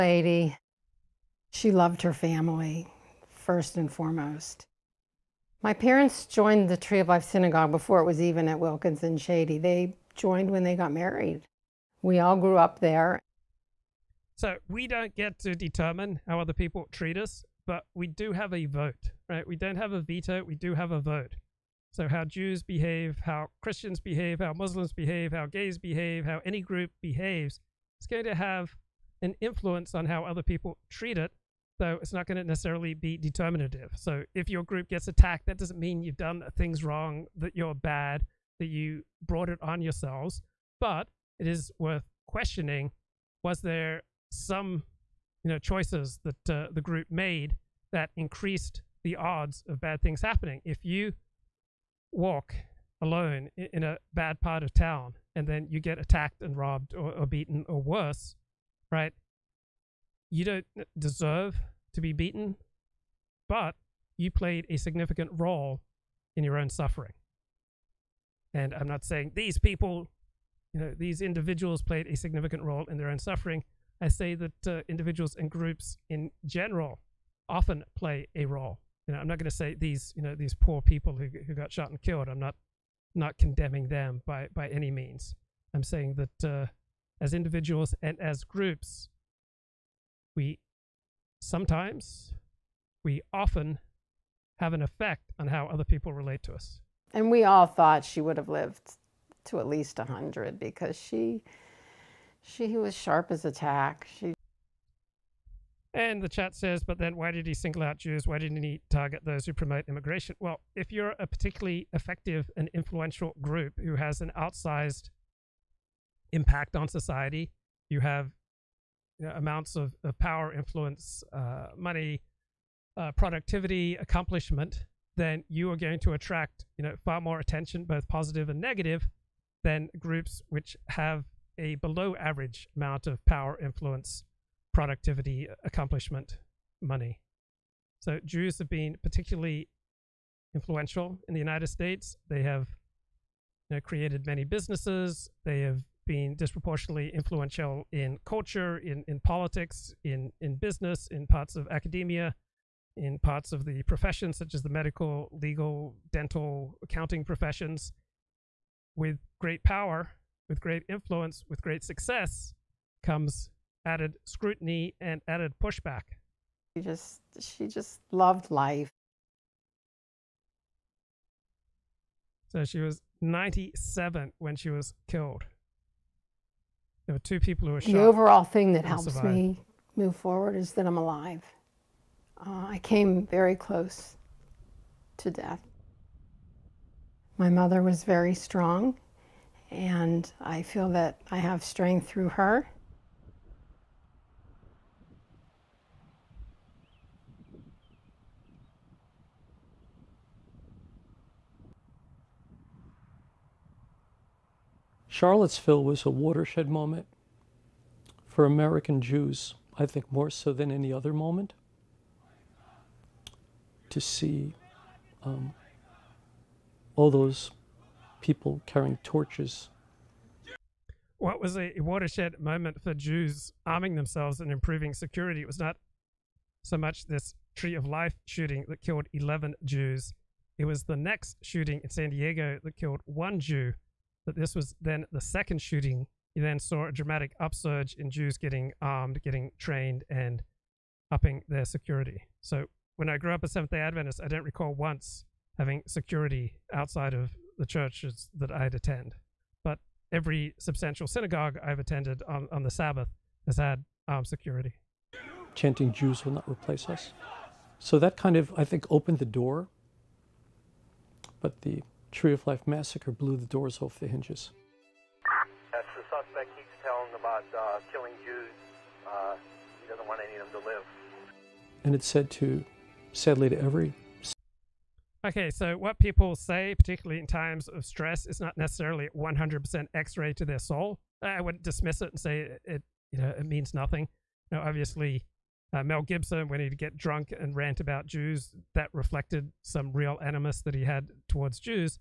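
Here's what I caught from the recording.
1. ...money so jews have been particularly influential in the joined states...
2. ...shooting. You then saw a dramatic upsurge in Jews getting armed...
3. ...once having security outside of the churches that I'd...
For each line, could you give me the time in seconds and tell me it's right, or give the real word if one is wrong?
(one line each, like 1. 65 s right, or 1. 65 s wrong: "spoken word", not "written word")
1. 136 s wrong: "united", not "joined"
2. 235 s right
3. 244 s right.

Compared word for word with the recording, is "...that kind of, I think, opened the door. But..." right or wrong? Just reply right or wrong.
right.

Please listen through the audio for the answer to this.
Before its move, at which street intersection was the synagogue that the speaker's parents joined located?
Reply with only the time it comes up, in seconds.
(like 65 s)
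8 s.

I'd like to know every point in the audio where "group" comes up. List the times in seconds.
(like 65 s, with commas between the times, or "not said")
26 s, 34 s, 46 s, 75 s, 88 s, 113 s, 129 s.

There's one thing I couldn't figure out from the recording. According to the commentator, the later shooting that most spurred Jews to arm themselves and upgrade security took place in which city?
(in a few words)
San Diego.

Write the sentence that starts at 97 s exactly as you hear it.
And we all thought she would have lived to at least 100 because she she was sharp as a tack.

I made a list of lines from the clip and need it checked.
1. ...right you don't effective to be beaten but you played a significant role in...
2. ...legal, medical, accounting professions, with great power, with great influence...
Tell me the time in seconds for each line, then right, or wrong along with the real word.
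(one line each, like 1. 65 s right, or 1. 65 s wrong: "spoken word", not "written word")
1. 58 s wrong: "deserve", not "effective"
2. 155 s wrong: "dental", not "medical".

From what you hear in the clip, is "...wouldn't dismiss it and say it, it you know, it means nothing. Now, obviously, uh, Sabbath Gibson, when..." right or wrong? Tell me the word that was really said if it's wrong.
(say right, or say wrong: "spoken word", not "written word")
wrong: "Mel", not "Sabbath".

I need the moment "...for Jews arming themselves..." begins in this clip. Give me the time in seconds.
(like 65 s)
222 s.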